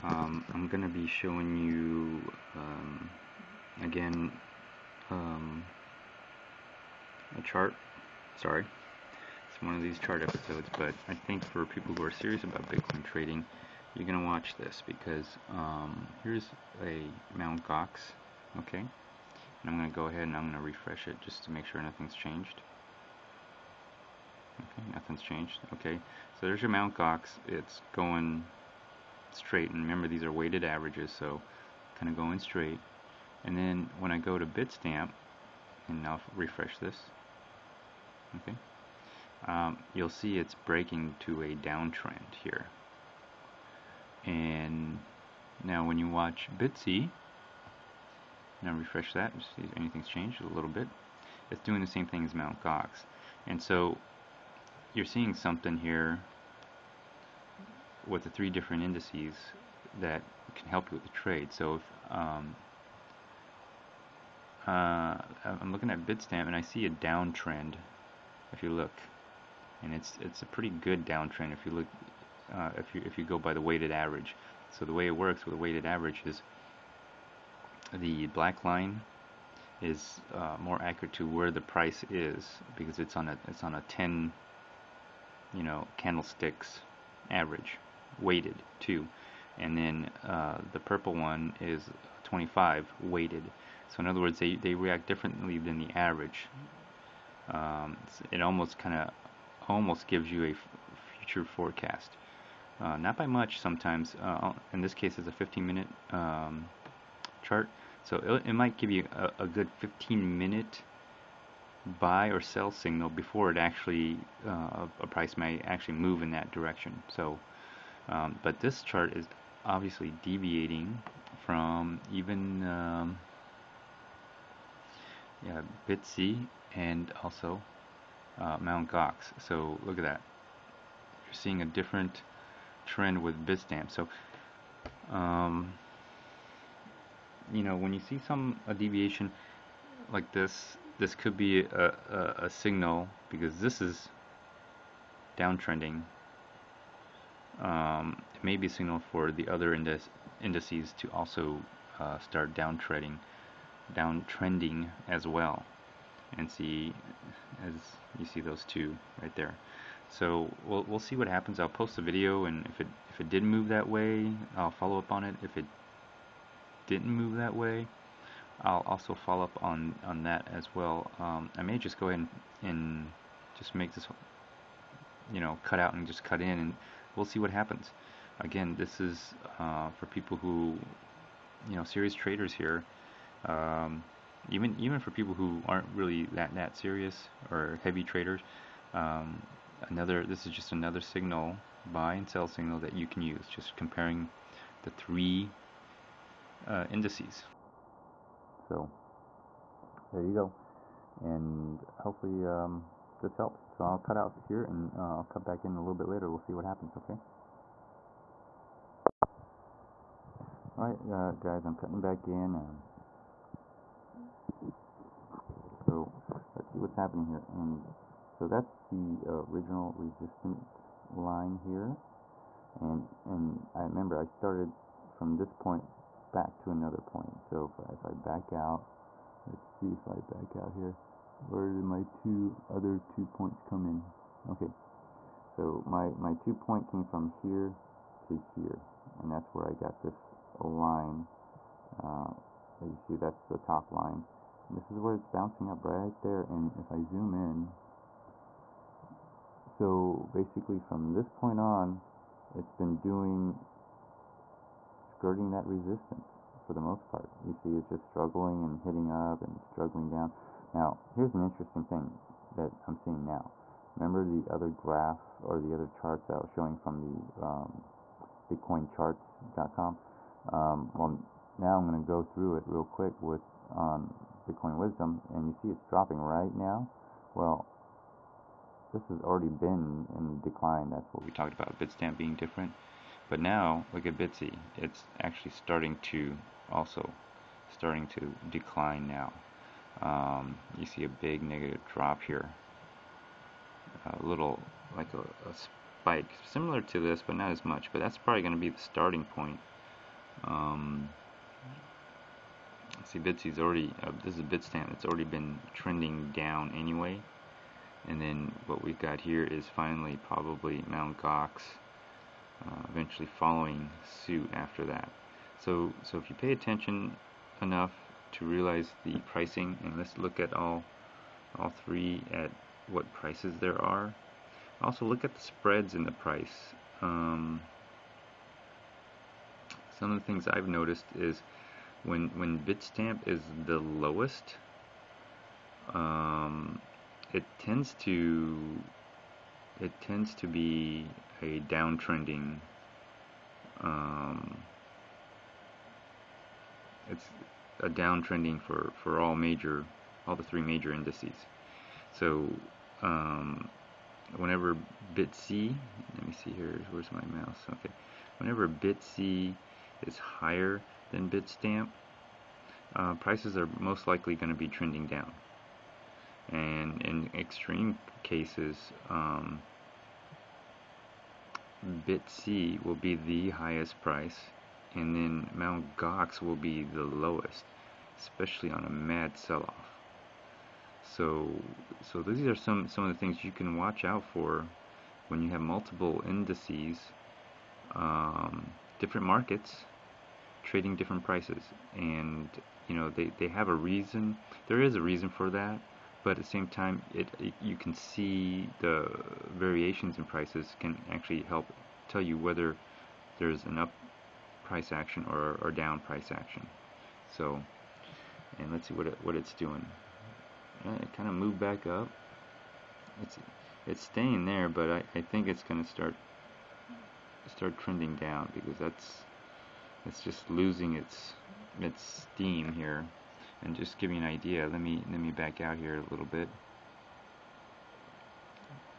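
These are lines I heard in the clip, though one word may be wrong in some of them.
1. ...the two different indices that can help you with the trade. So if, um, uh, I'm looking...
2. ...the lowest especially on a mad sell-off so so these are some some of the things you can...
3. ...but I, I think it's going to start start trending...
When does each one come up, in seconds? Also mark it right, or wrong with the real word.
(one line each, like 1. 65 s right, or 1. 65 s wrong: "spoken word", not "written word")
1. 58 s wrong: "three", not "two"
2. 376 s right
3. 414 s right.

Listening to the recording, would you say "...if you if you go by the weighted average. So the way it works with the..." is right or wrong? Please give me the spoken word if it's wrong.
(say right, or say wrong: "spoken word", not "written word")
right.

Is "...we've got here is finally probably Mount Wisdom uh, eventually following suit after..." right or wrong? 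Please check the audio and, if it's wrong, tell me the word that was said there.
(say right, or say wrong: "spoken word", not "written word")
wrong: "Gox", not "Wisdom".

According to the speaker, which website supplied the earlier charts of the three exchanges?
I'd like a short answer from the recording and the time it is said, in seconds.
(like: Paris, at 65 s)
BitcoinCharts.com, at 268 s.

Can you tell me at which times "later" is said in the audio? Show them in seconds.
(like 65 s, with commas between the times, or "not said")
206 s.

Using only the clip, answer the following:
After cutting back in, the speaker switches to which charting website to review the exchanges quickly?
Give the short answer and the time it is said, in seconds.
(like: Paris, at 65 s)
Bitcoin Wisdom, at 274 s.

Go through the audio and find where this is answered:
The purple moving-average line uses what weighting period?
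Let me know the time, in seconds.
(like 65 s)
92 s.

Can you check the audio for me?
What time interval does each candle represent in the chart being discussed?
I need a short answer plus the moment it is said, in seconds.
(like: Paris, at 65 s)
15 minutes, at 105 s.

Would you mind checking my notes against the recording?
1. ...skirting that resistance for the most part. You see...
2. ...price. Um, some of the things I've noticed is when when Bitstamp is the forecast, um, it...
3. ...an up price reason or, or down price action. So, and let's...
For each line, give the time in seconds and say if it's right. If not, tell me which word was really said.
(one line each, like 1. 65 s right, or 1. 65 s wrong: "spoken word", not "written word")
1. 255 s right
2. 326 s wrong: "lowest", not "forecast"
3. 403 s wrong: "action", not "reason".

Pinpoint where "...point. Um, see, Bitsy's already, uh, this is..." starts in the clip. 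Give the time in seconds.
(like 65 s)
299 s.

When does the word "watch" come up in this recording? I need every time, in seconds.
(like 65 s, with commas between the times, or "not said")
14 s, 46 s, 383 s.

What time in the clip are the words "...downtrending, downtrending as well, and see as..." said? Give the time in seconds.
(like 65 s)
152 s.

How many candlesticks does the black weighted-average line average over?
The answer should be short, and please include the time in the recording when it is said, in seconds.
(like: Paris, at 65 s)
10, at 83 s.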